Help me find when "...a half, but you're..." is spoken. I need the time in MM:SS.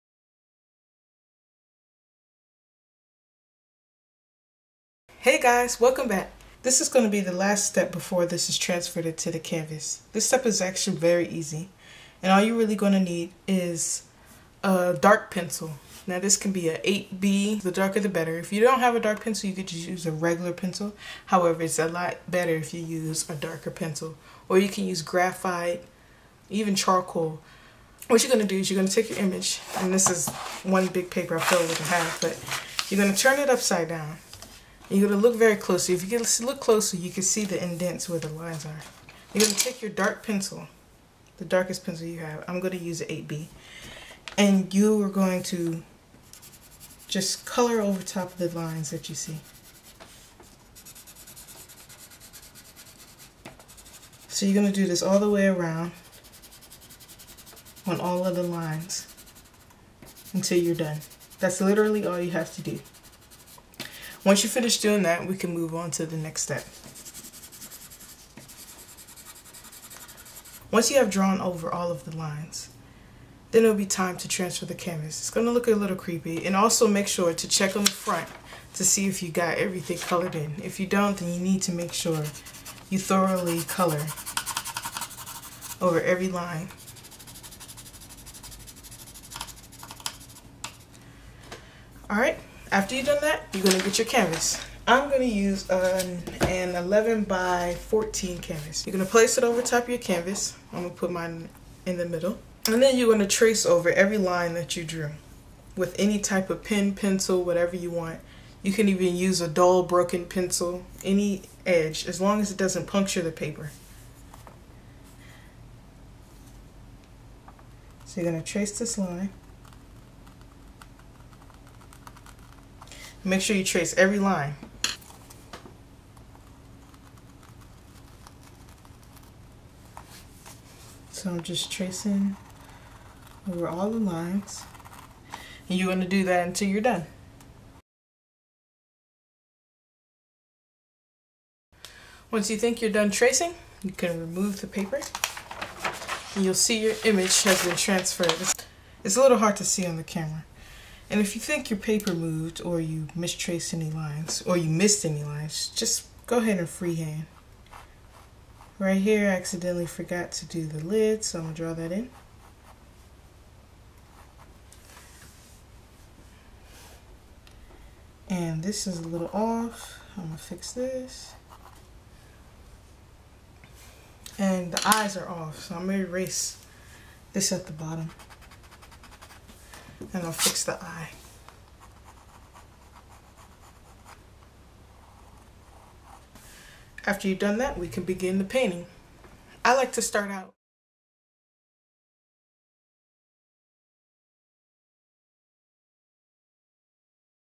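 00:31.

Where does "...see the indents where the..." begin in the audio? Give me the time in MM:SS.
00:37.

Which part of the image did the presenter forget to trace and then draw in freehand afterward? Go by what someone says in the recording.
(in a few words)
the lid.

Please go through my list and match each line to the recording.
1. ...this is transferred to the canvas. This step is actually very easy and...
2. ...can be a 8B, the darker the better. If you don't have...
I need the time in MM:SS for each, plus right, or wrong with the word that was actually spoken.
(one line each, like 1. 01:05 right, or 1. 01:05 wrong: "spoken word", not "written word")
1. 00:08 right
2. 00:16 right.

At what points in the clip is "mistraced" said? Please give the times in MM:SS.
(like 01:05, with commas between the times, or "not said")
02:33.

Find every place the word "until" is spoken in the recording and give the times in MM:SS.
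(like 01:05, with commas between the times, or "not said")
01:00, 02:16.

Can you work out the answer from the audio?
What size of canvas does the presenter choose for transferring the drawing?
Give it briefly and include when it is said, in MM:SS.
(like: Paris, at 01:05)
11 by 14, at 01:36.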